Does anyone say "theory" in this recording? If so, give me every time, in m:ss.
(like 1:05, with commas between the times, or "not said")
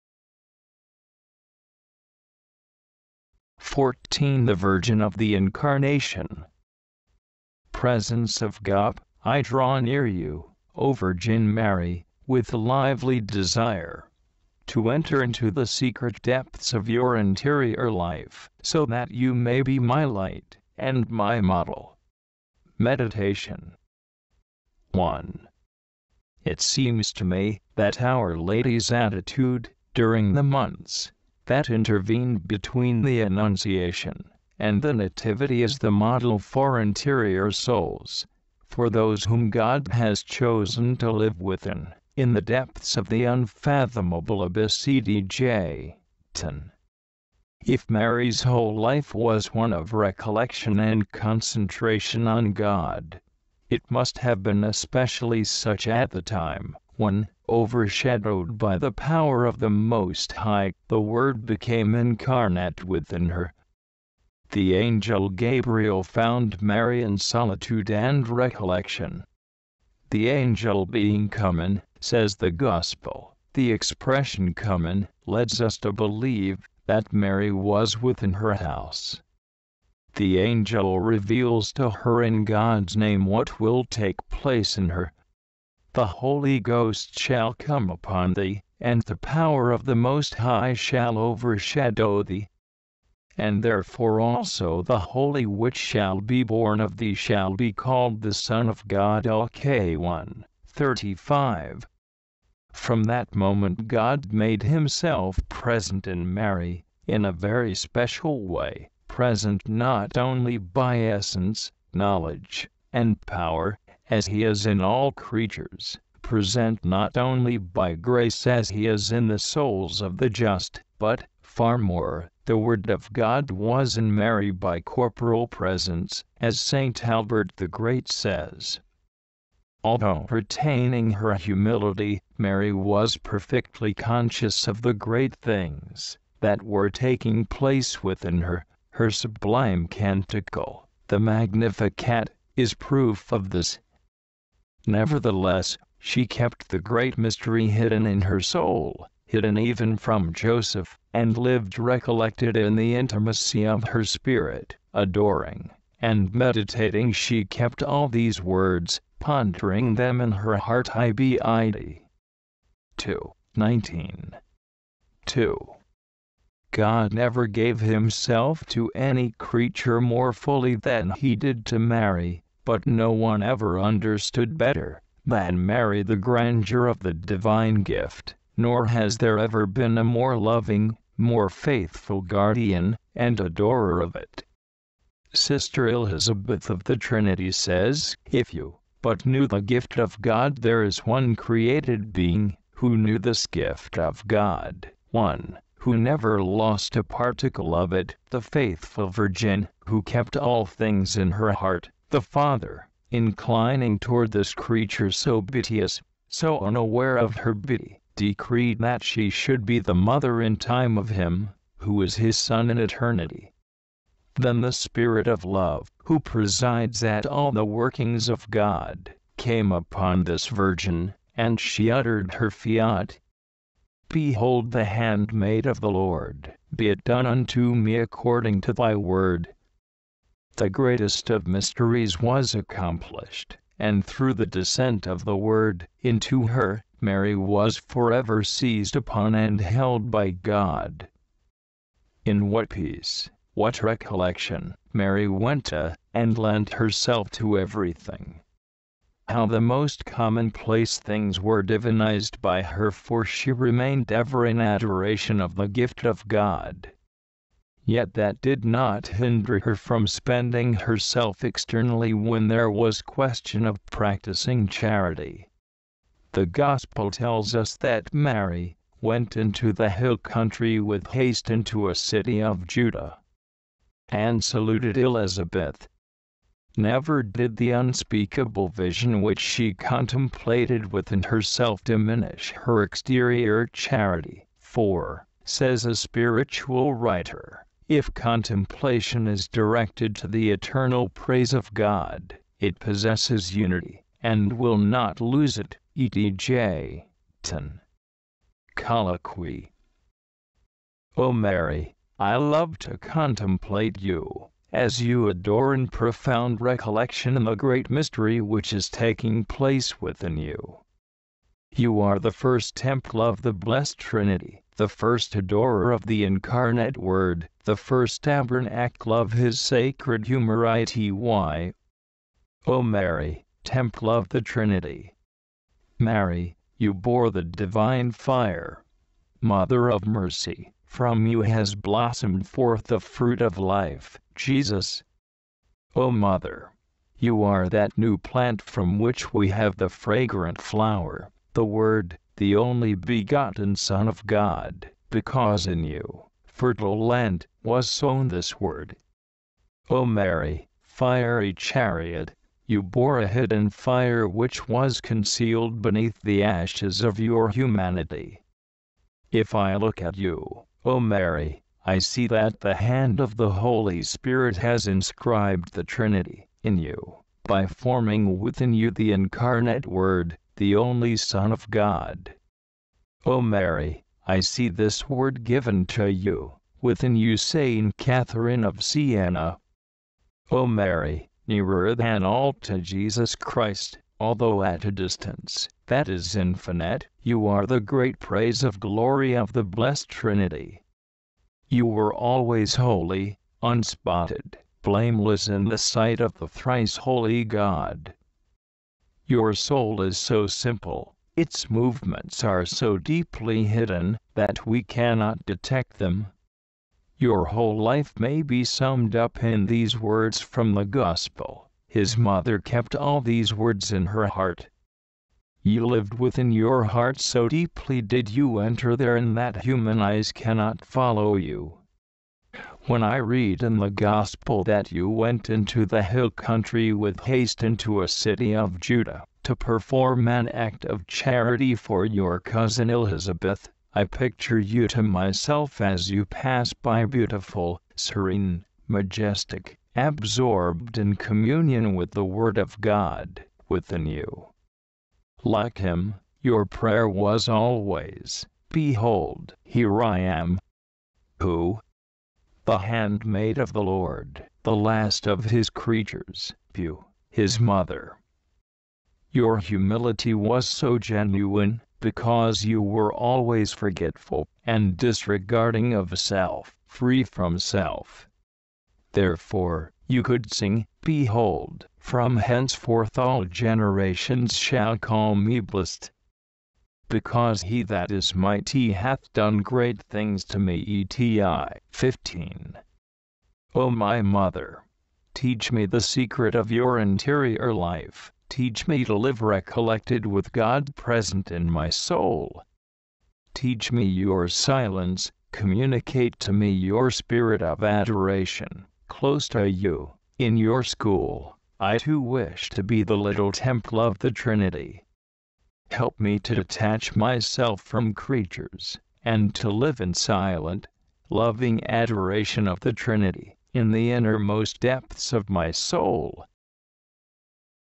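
not said.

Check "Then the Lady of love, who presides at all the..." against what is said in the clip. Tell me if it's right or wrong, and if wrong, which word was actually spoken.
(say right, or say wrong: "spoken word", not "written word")
wrong: "Spirit", not "Lady".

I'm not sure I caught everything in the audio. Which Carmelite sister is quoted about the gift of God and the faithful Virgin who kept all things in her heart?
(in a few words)
Sister Elizabeth of the Trinity.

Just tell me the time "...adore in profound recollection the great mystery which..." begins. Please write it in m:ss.
5:05.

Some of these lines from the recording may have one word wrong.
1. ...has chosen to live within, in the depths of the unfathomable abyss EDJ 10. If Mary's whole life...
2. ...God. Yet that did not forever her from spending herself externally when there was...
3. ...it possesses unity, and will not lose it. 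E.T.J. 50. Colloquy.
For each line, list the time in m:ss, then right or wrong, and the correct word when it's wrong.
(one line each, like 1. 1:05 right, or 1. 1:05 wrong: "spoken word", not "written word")
1. 0:39 right
2. 4:16 wrong: "hinder", not "forever"
3. 4:52 wrong: "10", not "50".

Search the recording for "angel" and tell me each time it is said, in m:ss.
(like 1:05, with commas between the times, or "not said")
1:04, 1:10, 1:20.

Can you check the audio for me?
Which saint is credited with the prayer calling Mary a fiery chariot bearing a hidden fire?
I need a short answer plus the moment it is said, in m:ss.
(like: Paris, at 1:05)
Saint Catherine of Siena, at 6:17.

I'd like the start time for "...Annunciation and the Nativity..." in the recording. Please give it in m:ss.
0:33.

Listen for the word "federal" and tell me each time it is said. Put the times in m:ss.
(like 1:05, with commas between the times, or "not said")
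not said.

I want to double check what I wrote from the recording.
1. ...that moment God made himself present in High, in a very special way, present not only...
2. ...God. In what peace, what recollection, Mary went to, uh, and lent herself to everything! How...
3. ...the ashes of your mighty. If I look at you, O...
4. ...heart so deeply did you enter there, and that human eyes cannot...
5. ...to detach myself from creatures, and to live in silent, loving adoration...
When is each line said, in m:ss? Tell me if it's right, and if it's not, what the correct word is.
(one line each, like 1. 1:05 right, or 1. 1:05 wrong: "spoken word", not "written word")
1. 1:43 wrong: "Mary", not "High"
2. 4:00 right
3. 5:56 wrong: "humanity", not "mighty"
4. 6:56 right
5. 8:26 right.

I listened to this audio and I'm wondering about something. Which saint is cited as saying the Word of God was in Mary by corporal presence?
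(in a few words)
St. Albert the Great.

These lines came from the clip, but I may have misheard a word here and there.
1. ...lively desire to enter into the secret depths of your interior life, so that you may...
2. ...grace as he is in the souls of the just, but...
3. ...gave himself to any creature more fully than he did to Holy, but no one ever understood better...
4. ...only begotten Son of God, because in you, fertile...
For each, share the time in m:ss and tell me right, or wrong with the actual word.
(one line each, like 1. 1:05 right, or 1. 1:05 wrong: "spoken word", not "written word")
1. 0:12 right
2. 1:57 right
3. 2:47 wrong: "Mary", not "Holy"
4. 5:42 right.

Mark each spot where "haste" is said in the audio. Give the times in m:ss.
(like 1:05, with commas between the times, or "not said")
4:31, 7:07.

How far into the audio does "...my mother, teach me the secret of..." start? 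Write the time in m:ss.
8:03.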